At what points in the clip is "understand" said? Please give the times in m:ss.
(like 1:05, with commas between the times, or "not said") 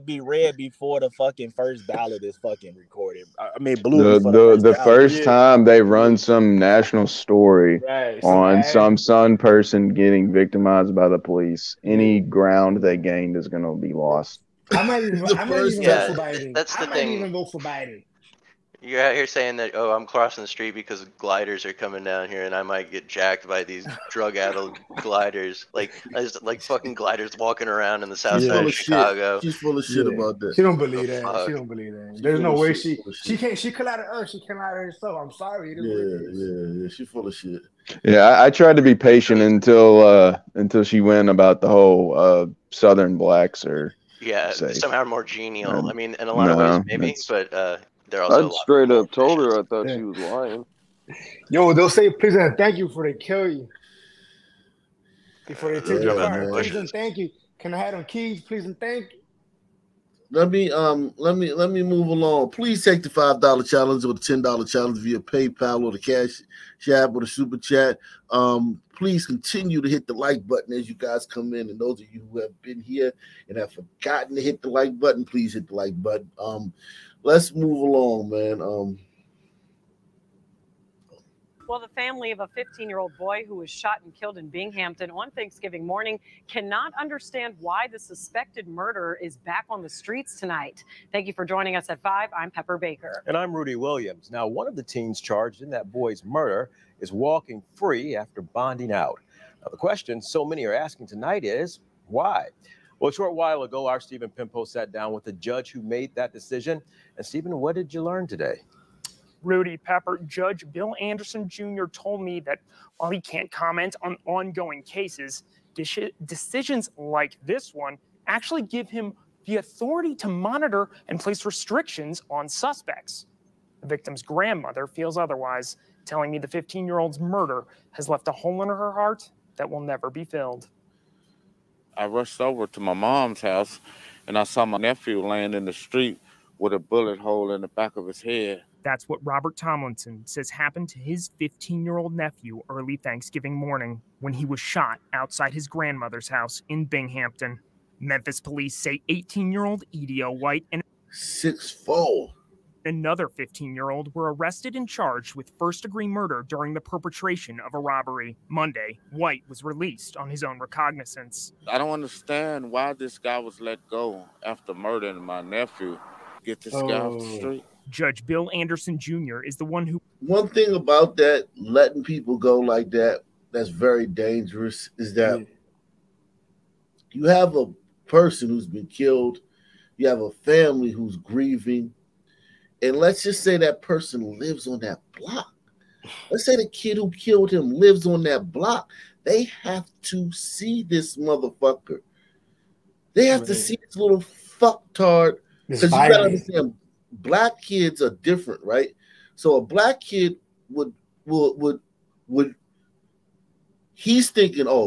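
1:26, 2:41, 3:16.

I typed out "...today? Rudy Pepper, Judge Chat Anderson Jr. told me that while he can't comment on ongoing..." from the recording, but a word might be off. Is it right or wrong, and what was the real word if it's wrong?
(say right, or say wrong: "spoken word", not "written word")
wrong: "Bill", not "Chat".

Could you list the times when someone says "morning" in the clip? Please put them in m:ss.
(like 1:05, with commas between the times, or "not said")
1:25, 2:23.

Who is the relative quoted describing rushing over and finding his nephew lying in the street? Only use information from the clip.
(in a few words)
Robert Tomlinson.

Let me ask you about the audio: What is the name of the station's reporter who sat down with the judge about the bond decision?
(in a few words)
Stephen Pimpo.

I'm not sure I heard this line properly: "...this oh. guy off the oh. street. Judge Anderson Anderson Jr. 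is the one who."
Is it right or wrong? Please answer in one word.
wrong.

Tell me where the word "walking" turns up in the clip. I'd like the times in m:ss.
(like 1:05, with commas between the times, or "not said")
0:27, 1:37.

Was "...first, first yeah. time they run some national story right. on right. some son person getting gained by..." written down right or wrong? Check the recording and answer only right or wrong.
wrong.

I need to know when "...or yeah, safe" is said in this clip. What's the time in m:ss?
0:43.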